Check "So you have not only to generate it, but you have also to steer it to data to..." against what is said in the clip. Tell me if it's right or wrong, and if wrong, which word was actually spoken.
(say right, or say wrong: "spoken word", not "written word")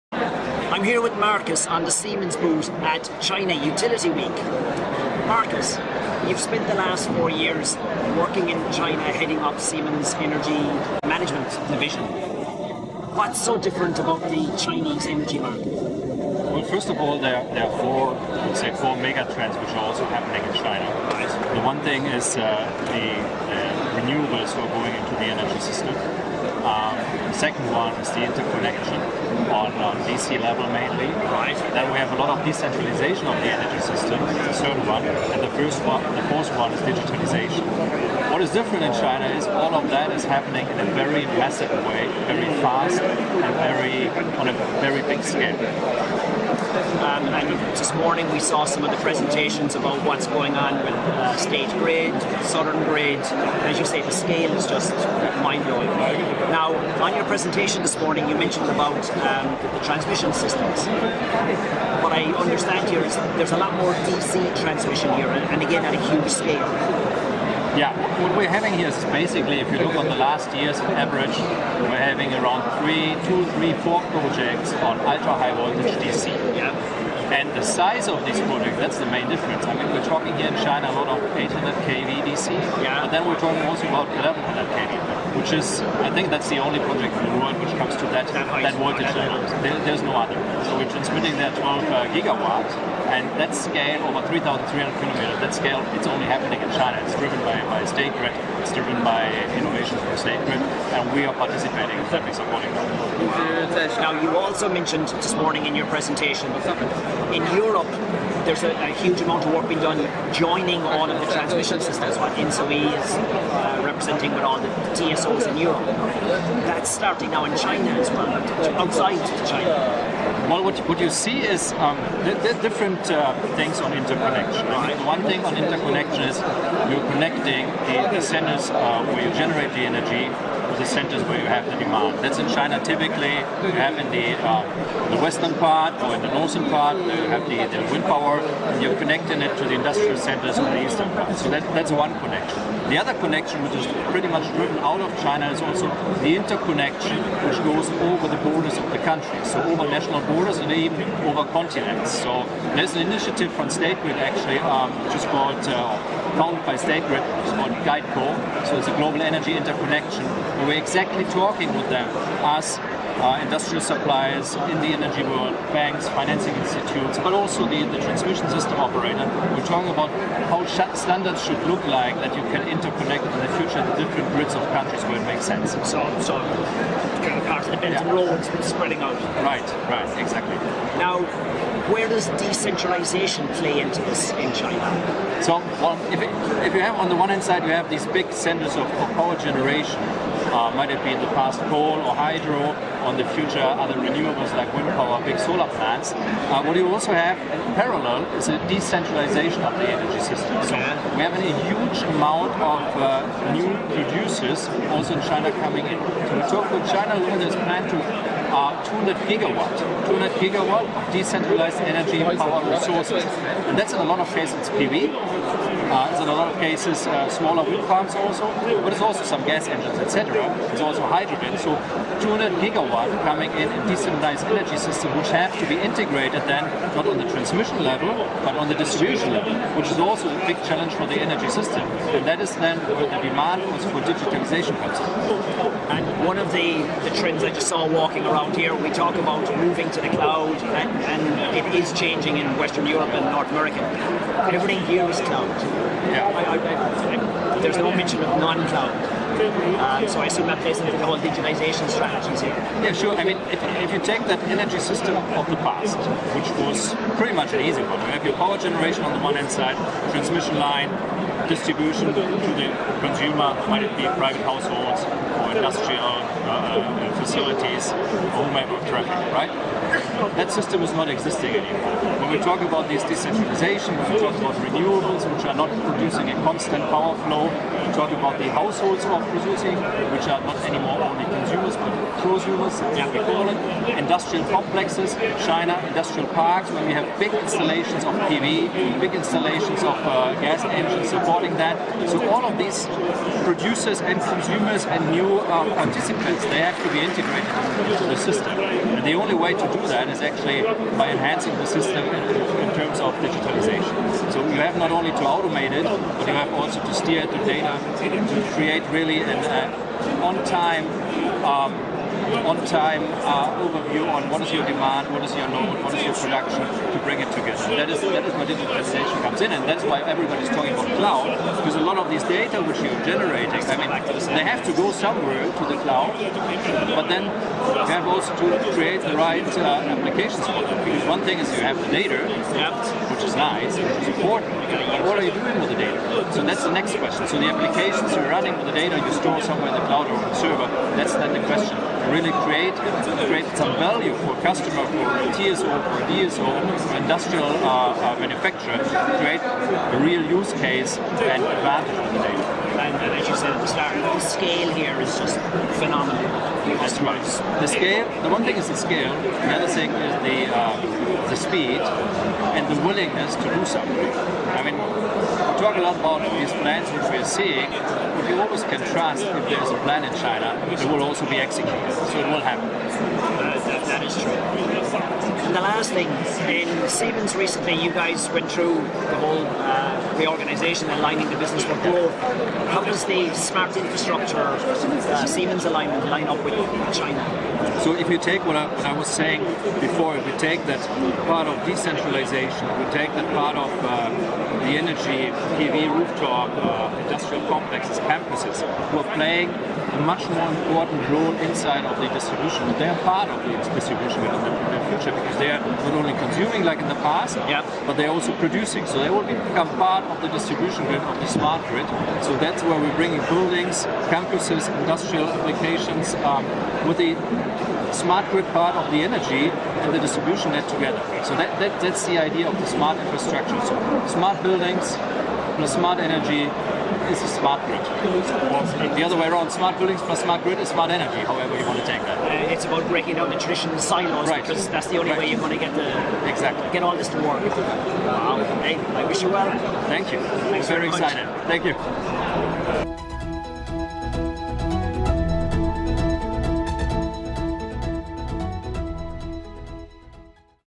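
wrong: "automate", not "generate".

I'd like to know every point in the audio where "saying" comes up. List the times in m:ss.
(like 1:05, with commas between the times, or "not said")
6:29.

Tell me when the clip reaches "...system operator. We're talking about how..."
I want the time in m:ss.
2:48.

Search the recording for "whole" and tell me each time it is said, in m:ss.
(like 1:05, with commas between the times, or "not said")
4:11, 6:19.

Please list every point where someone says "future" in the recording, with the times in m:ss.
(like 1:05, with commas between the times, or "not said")
2:53, 3:13, 6:44.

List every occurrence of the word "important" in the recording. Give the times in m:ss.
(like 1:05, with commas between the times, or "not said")
5:34, 6:40.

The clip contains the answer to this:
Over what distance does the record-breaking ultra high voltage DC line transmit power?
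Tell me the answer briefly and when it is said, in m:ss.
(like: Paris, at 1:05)
3,300 kilometers, at 1:34.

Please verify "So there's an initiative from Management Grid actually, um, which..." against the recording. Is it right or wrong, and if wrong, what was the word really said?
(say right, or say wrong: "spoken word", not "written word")
wrong: "State", not "Management".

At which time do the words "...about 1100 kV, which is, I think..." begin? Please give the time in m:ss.
1:23.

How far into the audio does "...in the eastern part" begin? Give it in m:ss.
2:20.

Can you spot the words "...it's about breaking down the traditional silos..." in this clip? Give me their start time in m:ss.
7:12.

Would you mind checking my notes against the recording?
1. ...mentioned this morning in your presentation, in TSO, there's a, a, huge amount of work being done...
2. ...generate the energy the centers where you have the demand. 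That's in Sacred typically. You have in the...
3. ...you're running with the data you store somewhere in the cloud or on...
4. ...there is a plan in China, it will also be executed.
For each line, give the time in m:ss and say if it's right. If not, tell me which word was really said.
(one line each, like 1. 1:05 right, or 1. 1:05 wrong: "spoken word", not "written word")
1. 1:44 wrong: "Europe", not "TSO"
2. 2:09 wrong: "China", not "Sacred"
3. 5:38 right
4. 6:09 right.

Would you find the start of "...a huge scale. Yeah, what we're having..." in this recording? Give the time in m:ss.
1:05.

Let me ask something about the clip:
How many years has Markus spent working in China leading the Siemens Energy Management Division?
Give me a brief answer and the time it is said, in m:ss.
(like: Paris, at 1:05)
4, at 0:07.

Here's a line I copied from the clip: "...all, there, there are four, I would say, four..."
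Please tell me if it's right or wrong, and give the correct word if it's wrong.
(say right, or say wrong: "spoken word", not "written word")
right.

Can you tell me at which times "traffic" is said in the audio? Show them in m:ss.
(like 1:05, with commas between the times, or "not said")
4:28.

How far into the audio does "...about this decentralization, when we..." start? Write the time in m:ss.
4:32.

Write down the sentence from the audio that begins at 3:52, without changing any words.
And that is then where the demand for digitalization comes in.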